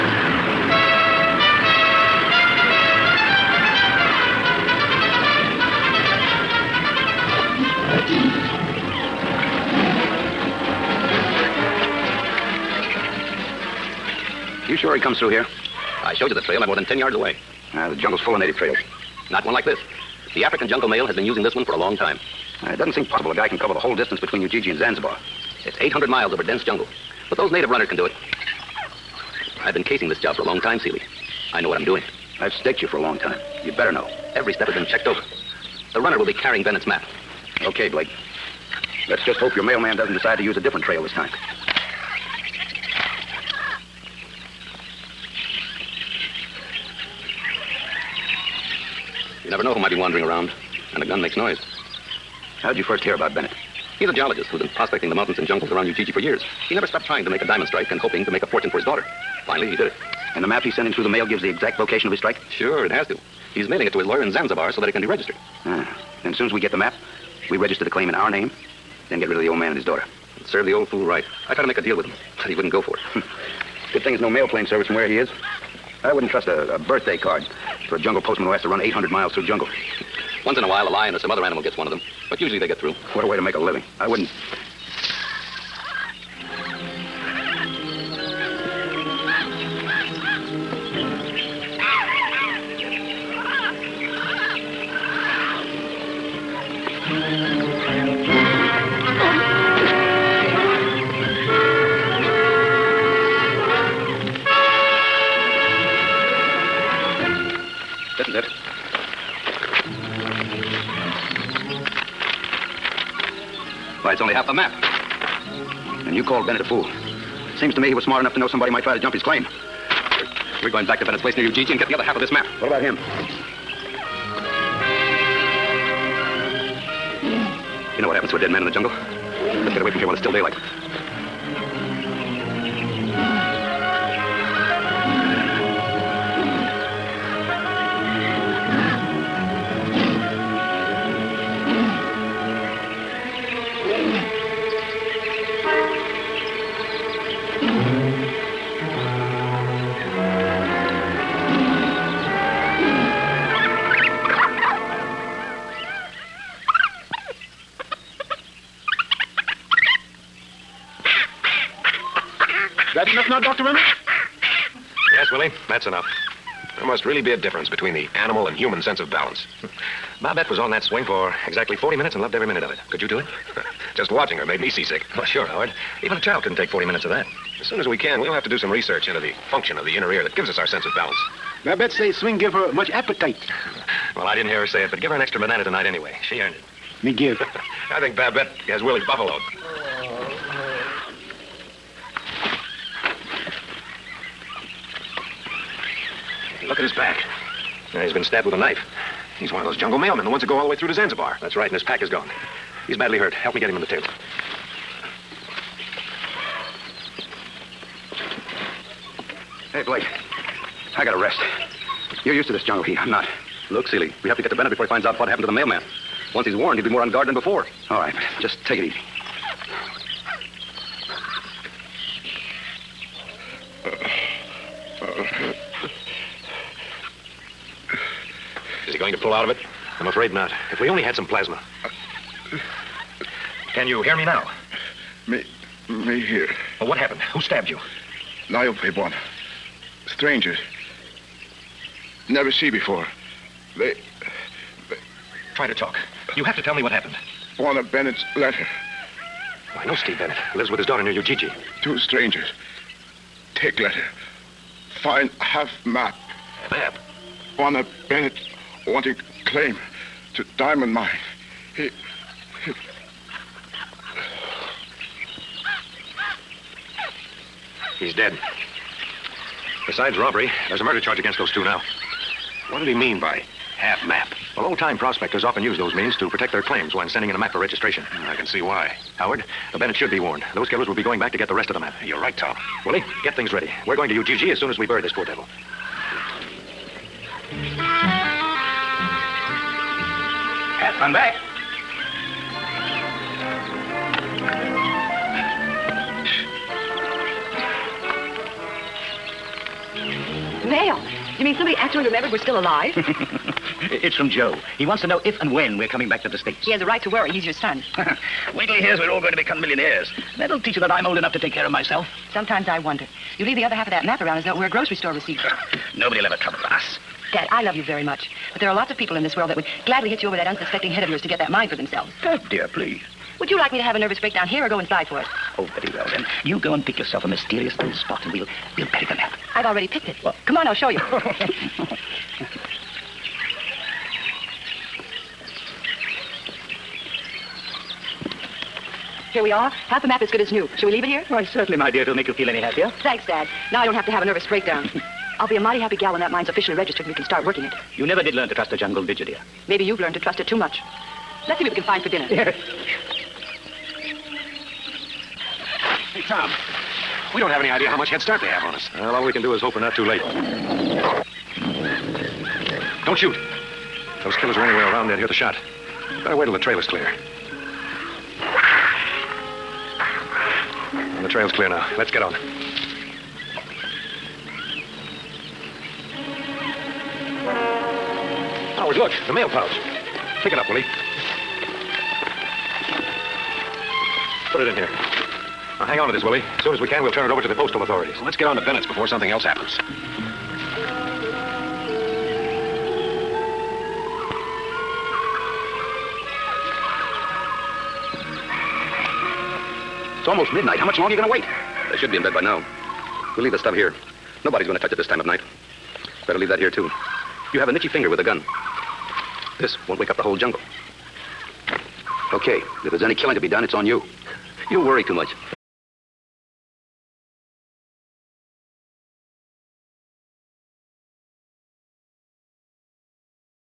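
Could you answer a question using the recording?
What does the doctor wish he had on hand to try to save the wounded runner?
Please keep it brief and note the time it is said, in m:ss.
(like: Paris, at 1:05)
plasma, at 3:51.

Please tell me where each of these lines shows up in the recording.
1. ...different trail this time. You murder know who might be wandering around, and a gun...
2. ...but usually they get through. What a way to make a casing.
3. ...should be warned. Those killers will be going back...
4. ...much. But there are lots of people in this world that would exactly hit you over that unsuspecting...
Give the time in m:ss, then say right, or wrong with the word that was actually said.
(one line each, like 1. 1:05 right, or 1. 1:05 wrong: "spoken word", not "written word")
1. 0:40 wrong: "never", not "murder"
2. 1:22 wrong: "living", not "casing"
3. 4:39 right
4. 5:18 wrong: "gladly", not "exactly".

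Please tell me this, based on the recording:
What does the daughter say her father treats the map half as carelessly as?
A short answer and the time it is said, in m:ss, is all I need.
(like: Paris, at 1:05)
a grocery store receipt, at 5:14.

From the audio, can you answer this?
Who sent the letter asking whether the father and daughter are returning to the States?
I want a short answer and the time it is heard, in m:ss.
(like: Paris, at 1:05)
Joe, at 5:04.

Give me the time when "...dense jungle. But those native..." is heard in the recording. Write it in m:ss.
0:26.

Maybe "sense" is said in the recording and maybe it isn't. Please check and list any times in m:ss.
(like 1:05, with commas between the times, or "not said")
2:48, 3:00.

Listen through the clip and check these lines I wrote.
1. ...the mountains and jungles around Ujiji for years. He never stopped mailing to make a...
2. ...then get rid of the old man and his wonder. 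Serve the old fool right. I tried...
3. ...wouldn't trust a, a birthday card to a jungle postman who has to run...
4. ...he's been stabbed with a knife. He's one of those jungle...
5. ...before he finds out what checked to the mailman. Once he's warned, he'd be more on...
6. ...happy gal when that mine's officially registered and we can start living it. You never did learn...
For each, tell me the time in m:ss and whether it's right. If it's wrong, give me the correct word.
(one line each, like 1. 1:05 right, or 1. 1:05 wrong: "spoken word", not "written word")
1. 0:55 wrong: "trying", not "mailing"
2. 1:09 wrong: "daughter", not "wonder"
3. 1:16 right
4. 3:18 right
5. 3:34 wrong: "happened", not "checked"
6. 5:45 wrong: "working", not "living".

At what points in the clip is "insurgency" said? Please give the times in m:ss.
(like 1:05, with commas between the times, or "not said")
not said.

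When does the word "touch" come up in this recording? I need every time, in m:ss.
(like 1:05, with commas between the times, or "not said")
6:44.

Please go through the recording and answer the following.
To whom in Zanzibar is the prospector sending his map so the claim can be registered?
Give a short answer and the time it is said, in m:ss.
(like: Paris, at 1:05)
his lawyer, at 1:03.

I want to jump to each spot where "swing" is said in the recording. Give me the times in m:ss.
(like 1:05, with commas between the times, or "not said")
2:50, 3:02.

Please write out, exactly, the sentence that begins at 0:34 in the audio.
Every step has been checked over.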